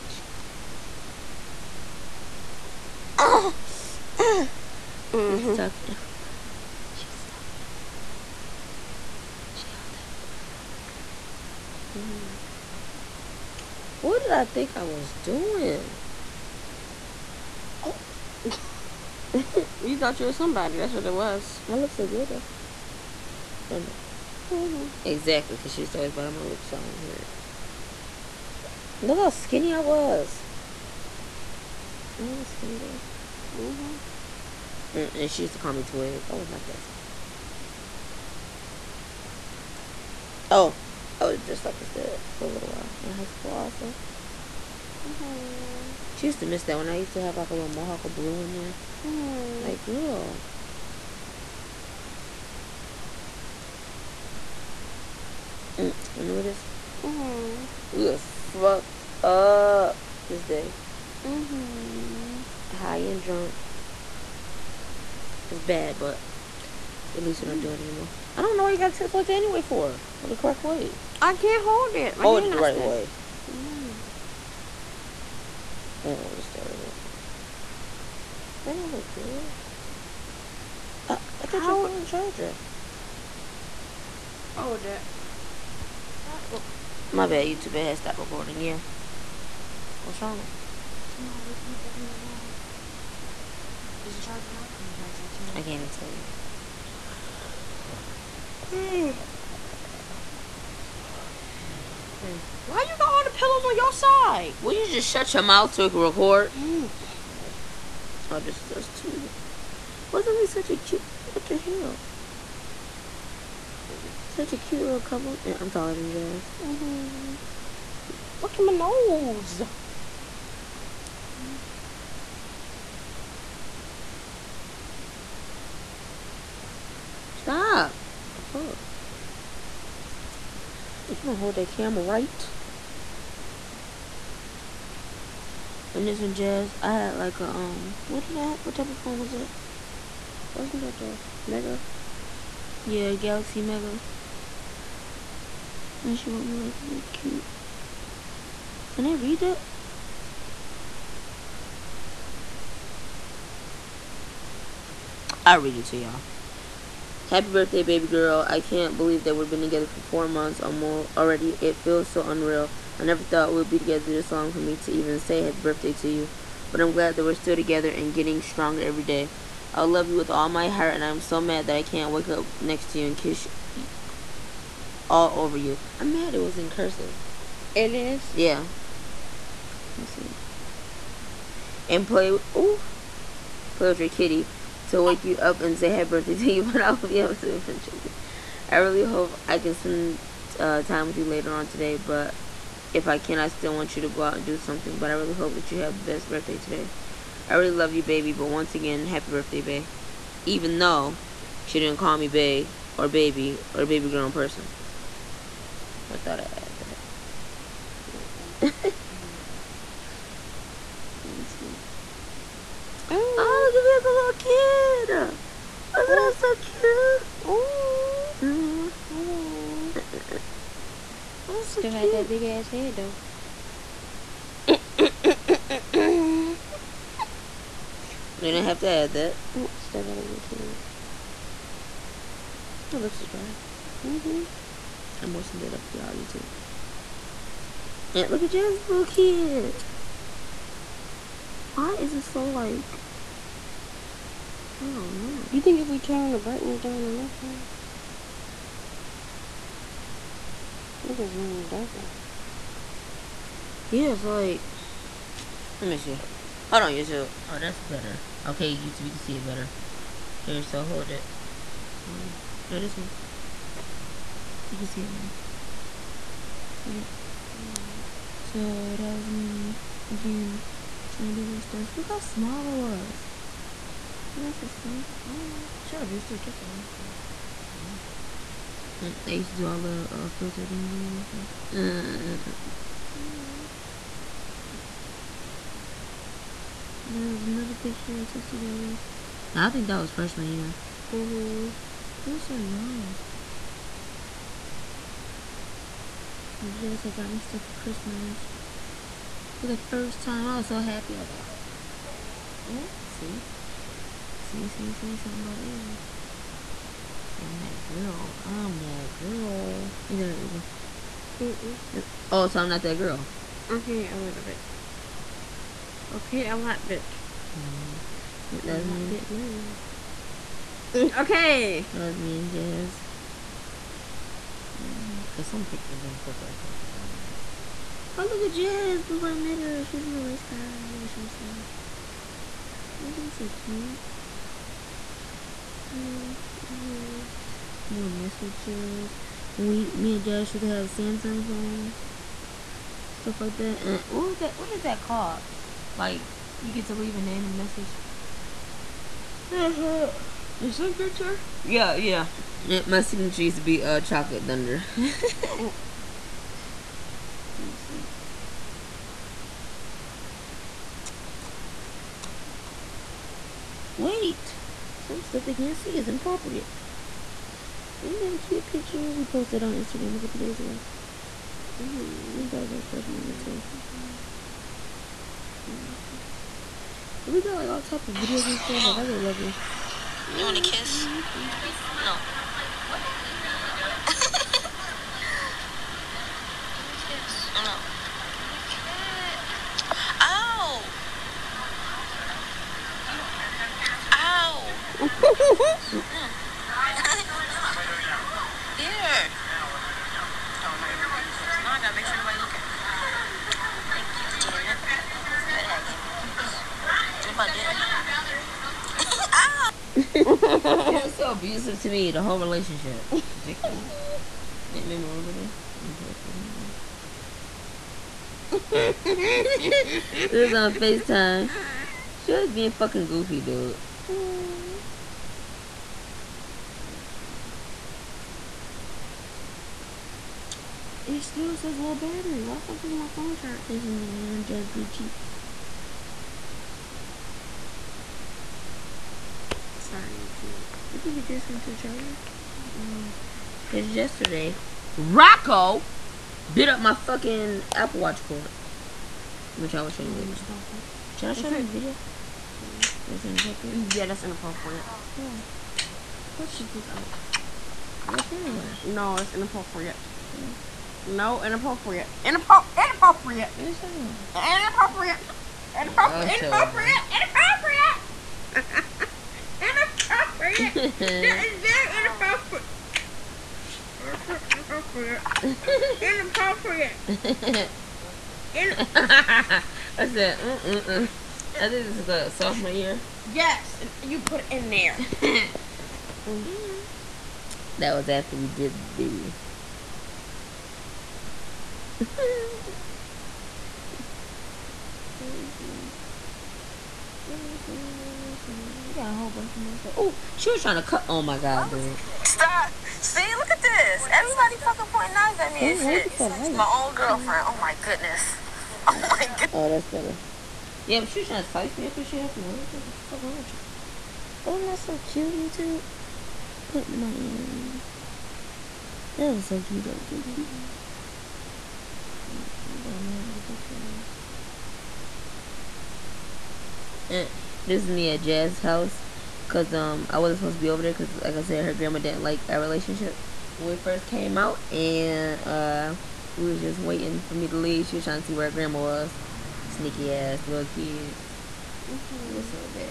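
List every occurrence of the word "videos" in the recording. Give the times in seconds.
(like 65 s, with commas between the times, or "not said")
378 s, 451 s.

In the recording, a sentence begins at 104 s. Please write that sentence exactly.
Will you just shut your mouth so we can record?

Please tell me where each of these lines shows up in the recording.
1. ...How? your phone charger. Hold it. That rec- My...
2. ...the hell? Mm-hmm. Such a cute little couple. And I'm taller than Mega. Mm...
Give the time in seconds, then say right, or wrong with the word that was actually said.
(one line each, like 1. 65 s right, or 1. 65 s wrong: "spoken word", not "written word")
1. 81 s right
2. 111 s wrong: "Jazz", not "Mega".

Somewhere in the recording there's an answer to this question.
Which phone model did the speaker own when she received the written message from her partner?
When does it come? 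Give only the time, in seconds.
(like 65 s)
143 s.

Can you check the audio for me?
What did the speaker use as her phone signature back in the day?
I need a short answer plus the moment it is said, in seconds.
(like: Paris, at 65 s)
Chocolate Thunder, at 354 s.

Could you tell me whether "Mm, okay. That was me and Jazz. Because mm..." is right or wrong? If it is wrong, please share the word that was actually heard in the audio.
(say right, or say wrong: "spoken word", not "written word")
right.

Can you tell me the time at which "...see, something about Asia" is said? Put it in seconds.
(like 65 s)
304 s.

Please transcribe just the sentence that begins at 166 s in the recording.
But I'm glad that we're still together and getting stronger every day.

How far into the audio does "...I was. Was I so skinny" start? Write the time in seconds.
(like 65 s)
272 s.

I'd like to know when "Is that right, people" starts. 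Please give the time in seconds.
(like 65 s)
310 s.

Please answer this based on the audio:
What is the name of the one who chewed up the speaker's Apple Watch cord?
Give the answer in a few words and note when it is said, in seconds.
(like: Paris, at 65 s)
Rocco, at 444 s.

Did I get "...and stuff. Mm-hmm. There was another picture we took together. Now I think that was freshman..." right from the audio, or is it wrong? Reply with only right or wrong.
right.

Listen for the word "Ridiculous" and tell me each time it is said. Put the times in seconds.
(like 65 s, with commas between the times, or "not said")
413 s.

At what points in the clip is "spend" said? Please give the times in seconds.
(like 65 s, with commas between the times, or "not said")
189 s.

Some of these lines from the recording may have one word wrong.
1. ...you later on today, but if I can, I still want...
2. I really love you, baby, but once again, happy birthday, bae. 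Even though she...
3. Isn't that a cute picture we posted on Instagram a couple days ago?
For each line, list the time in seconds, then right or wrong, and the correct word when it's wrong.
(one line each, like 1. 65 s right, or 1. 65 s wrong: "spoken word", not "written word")
1. 191 s right
2. 197 s right
3. 367 s right.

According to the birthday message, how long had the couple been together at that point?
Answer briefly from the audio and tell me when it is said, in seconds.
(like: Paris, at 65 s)
4 months, at 160 s.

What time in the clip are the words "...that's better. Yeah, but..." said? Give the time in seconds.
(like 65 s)
509 s.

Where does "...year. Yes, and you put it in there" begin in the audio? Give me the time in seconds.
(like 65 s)
482 s.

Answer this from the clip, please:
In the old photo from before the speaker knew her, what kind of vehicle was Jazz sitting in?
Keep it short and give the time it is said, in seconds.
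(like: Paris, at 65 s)
Race car, at 330 s.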